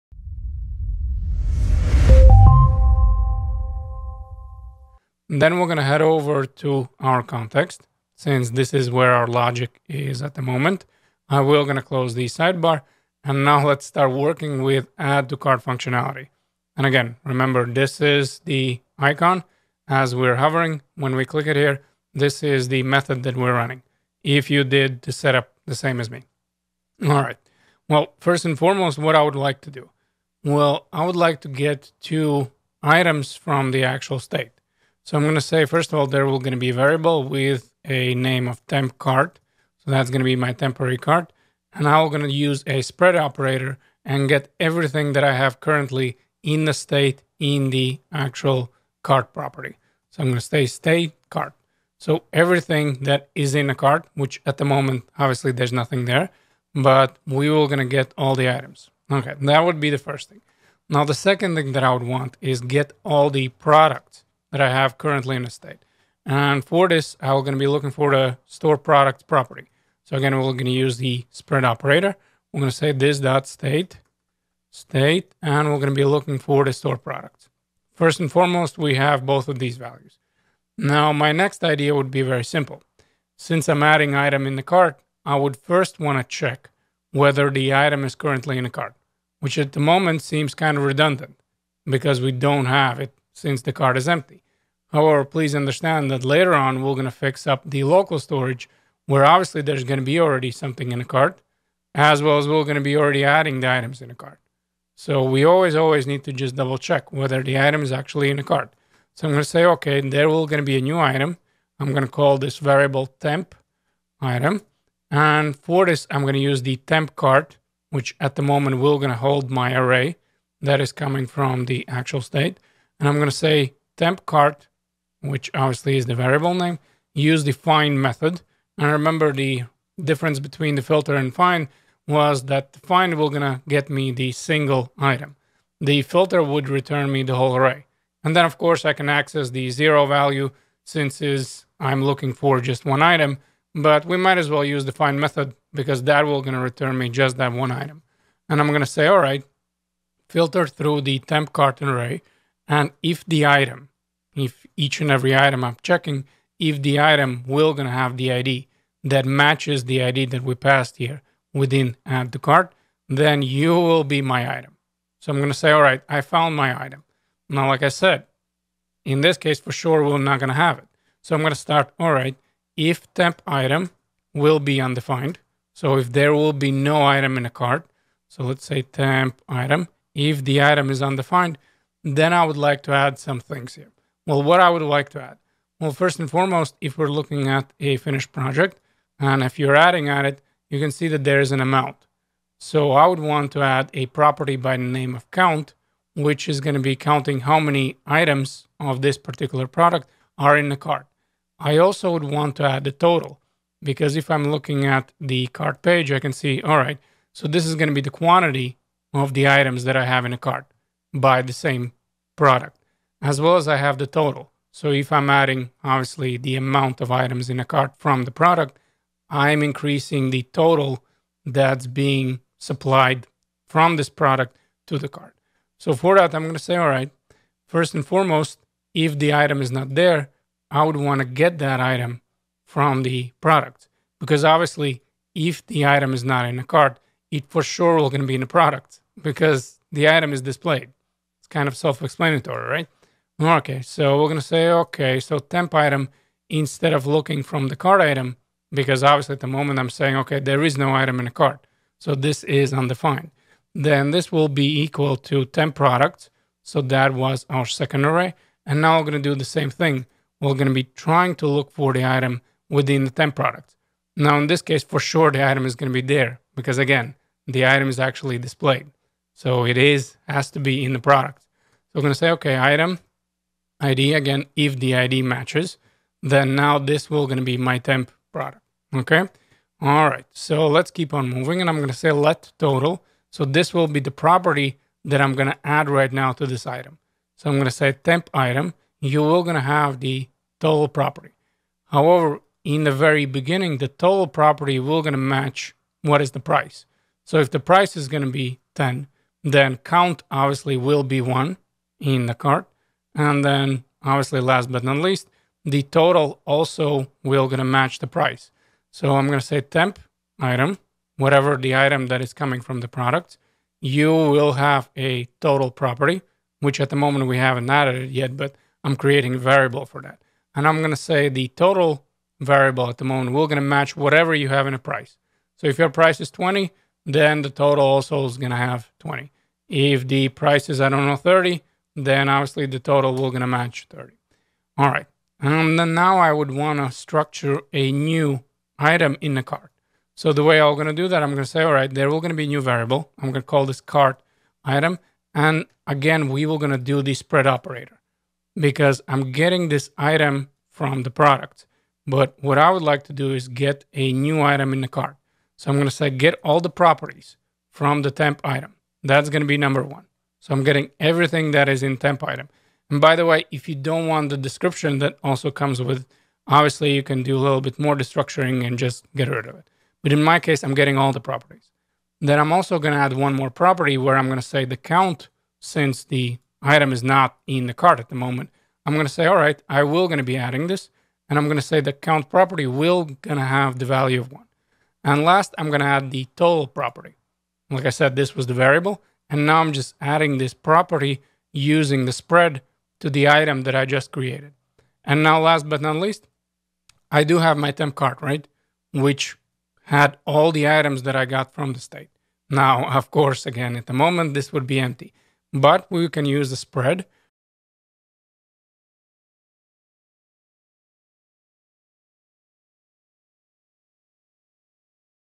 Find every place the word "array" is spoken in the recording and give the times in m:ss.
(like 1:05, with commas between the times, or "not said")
1:59, 2:17, 2:31, 4:18.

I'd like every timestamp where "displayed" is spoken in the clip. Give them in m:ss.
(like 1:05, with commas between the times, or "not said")
4:00, 4:28.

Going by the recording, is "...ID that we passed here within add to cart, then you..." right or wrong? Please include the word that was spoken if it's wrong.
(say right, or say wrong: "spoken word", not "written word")
right.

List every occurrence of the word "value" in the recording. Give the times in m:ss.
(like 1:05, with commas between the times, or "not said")
1:19, 2:20, 6:23.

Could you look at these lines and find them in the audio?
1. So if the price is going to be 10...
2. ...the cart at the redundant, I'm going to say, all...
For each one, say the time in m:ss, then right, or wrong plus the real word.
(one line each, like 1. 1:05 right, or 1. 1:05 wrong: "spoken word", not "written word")
1. 4:57 right
2. 6:17 wrong: "moment", not "redundant".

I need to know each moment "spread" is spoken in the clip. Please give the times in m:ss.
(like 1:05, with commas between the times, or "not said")
0:42, 1:11, 5:47, 6:32, 6:46.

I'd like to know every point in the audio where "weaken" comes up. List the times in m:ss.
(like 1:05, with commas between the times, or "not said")
not said.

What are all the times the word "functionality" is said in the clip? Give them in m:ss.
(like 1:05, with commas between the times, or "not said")
0:15.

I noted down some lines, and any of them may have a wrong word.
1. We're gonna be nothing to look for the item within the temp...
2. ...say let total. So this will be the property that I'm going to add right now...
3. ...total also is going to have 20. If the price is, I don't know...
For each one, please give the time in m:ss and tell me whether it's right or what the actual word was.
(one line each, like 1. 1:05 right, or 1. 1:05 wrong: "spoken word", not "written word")
1. 4:20 wrong: "trying", not "nothing"
2. 4:41 right
3. 5:27 right.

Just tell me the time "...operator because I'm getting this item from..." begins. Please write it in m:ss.
5:47.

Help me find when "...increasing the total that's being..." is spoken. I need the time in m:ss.
3:39.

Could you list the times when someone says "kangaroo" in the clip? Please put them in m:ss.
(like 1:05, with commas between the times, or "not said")
not said.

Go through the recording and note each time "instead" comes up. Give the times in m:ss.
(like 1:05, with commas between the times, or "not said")
4:06.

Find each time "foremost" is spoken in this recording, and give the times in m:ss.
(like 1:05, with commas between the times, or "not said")
0:28, 1:18, 3:06, 3:48.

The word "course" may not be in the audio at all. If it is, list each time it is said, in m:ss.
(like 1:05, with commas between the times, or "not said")
2:18, 6:43.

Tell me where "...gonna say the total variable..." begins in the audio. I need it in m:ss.
5:20.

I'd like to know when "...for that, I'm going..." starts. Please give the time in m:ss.
3:45.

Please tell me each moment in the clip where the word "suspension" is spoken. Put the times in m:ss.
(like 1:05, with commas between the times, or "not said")
not said.